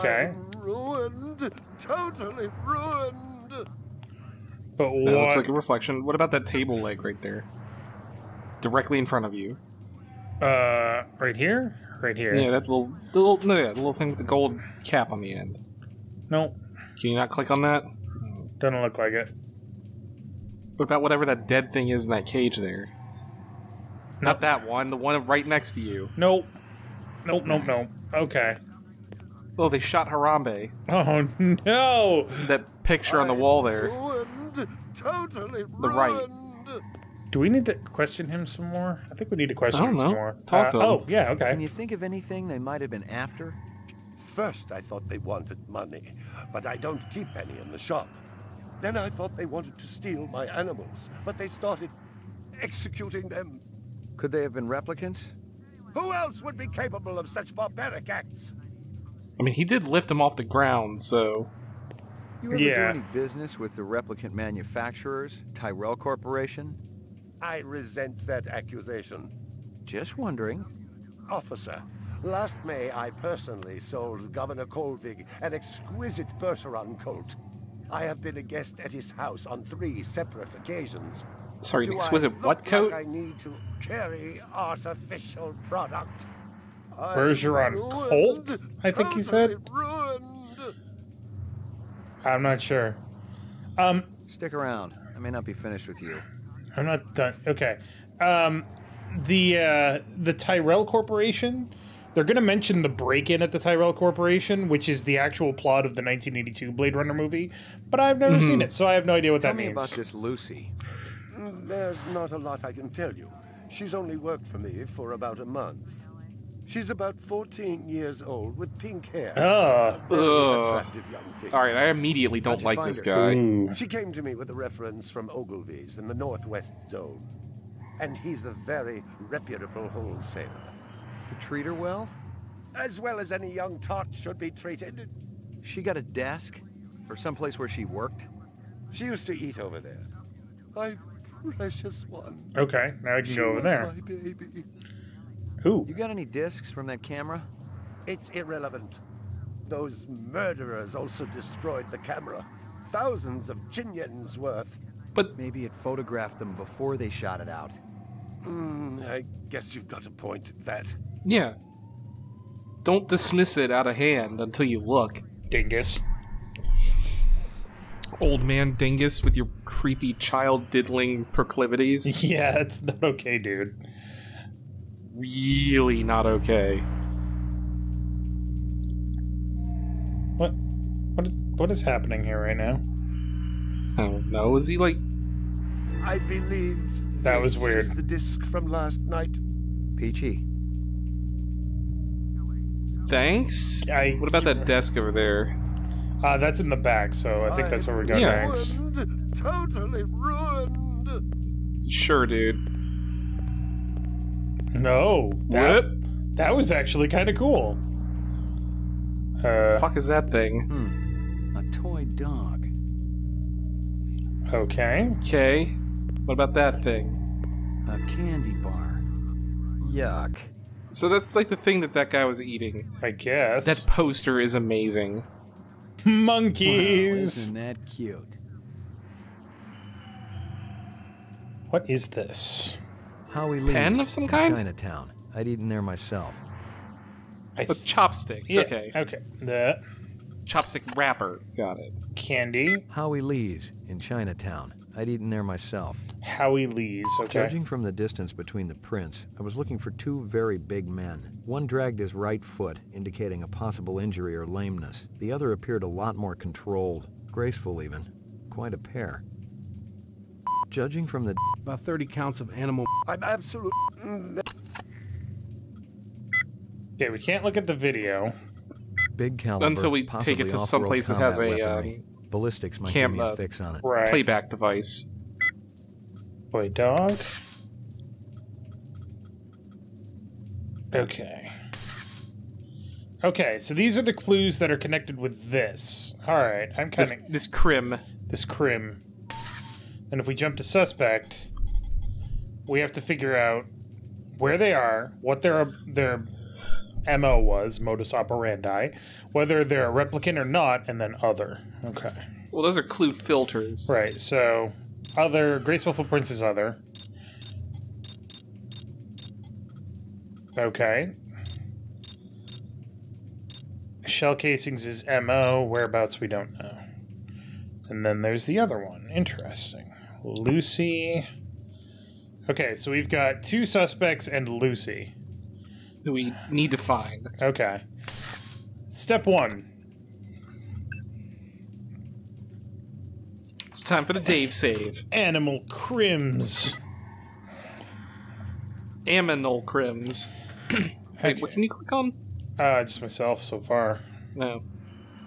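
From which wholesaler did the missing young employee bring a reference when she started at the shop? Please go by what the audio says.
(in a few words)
Ogilvy's.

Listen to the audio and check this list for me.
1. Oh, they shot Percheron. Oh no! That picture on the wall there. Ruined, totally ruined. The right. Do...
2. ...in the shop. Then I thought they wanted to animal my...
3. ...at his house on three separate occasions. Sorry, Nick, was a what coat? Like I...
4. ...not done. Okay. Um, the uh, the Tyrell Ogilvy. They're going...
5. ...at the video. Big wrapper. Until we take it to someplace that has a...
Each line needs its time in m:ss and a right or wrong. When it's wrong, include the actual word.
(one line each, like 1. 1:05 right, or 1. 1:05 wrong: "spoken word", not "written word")
1. 0:29 wrong: "Harambe", not "Percheron"
2. 0:47 wrong: "steal", not "animal"
3. 1:18 right
4. 1:36 wrong: "Corporation", not "Ogilvy"
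5. 4:27 wrong: "caliber", not "wrapper".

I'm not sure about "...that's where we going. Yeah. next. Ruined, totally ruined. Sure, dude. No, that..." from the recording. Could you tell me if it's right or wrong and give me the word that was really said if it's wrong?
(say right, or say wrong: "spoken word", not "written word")
right.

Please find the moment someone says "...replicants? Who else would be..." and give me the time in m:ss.
0:54.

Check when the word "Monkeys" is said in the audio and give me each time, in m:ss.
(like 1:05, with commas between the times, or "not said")
3:46.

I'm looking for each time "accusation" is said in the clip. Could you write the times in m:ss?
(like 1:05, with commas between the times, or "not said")
1:08.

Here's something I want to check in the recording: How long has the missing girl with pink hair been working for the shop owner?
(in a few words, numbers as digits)
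About a month.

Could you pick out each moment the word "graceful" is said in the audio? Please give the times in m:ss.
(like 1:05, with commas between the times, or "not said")
4:17, 5:05.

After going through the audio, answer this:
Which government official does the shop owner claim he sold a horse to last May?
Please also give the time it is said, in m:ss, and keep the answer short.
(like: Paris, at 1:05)
Governor Kolvig, at 1:14.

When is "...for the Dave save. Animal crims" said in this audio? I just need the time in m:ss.
5:34.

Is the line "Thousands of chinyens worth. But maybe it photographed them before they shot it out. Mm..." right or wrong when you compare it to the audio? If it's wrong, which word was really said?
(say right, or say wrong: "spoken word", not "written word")
right.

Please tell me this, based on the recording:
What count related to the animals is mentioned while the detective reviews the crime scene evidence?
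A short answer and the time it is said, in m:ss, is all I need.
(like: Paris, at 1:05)
30, at 4:21.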